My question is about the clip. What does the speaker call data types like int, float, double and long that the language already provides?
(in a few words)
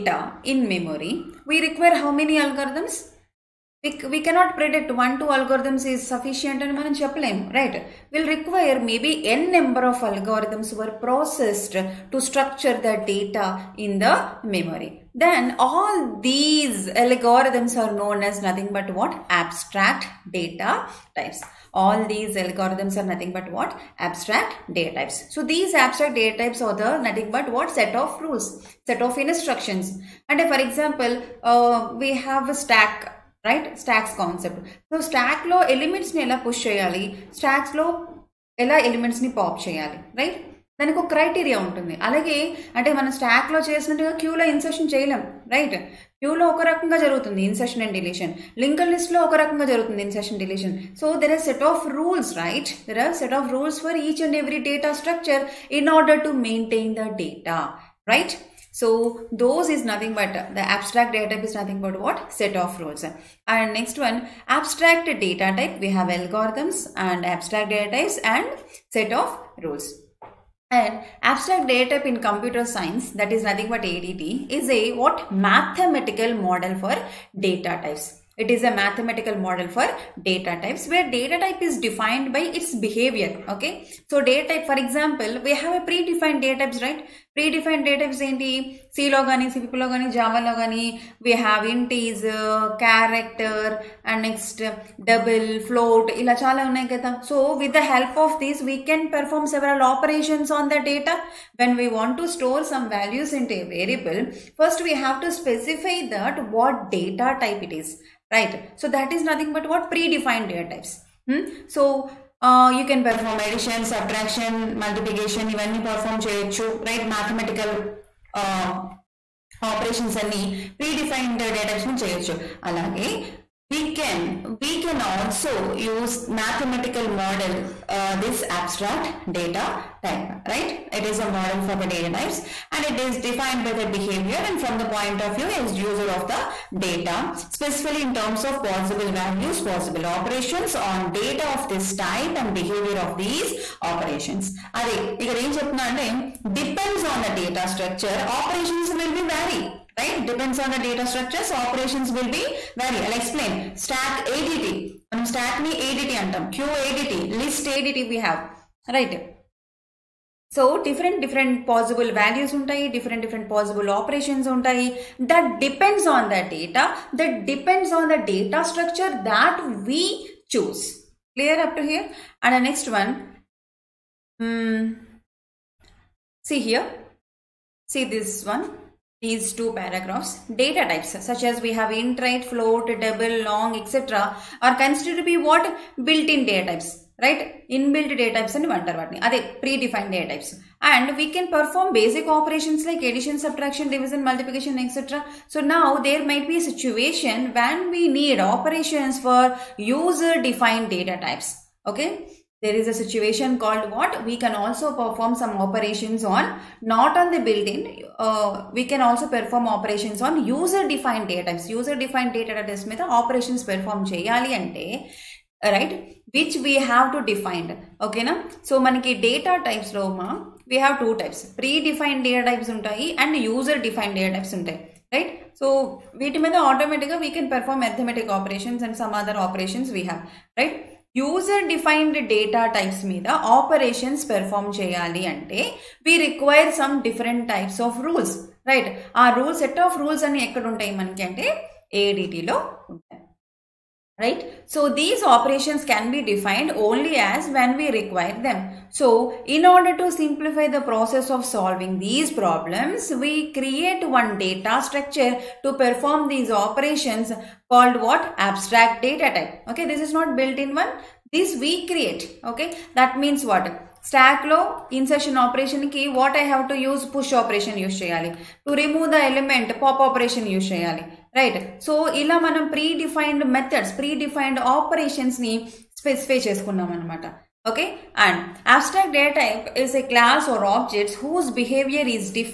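Built-in data types.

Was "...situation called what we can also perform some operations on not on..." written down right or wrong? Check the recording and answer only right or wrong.
right.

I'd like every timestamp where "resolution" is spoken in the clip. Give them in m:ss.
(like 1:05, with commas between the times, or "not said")
not said.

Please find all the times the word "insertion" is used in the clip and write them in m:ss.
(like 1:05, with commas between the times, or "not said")
4:24.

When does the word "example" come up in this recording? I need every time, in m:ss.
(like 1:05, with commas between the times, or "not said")
0:30, 1:24.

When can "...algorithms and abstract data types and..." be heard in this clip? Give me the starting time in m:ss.
1:06.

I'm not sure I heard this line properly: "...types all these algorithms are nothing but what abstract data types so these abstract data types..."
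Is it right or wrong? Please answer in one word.
right.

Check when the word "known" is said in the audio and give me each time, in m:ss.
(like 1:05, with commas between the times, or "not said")
0:17.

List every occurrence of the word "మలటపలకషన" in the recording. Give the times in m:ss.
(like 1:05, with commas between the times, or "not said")
1:54, 3:14.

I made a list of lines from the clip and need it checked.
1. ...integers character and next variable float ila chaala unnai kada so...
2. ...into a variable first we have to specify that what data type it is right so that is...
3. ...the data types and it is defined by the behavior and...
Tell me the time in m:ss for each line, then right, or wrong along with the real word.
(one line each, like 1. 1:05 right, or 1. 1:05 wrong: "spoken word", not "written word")
1. 1:31 wrong: "double", not "variable"
2. 1:43 right
3. 2:11 right.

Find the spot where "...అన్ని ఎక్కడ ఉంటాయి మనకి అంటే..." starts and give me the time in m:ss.
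4:00.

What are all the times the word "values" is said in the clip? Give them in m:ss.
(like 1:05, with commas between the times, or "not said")
1:42, 2:19, 2:42.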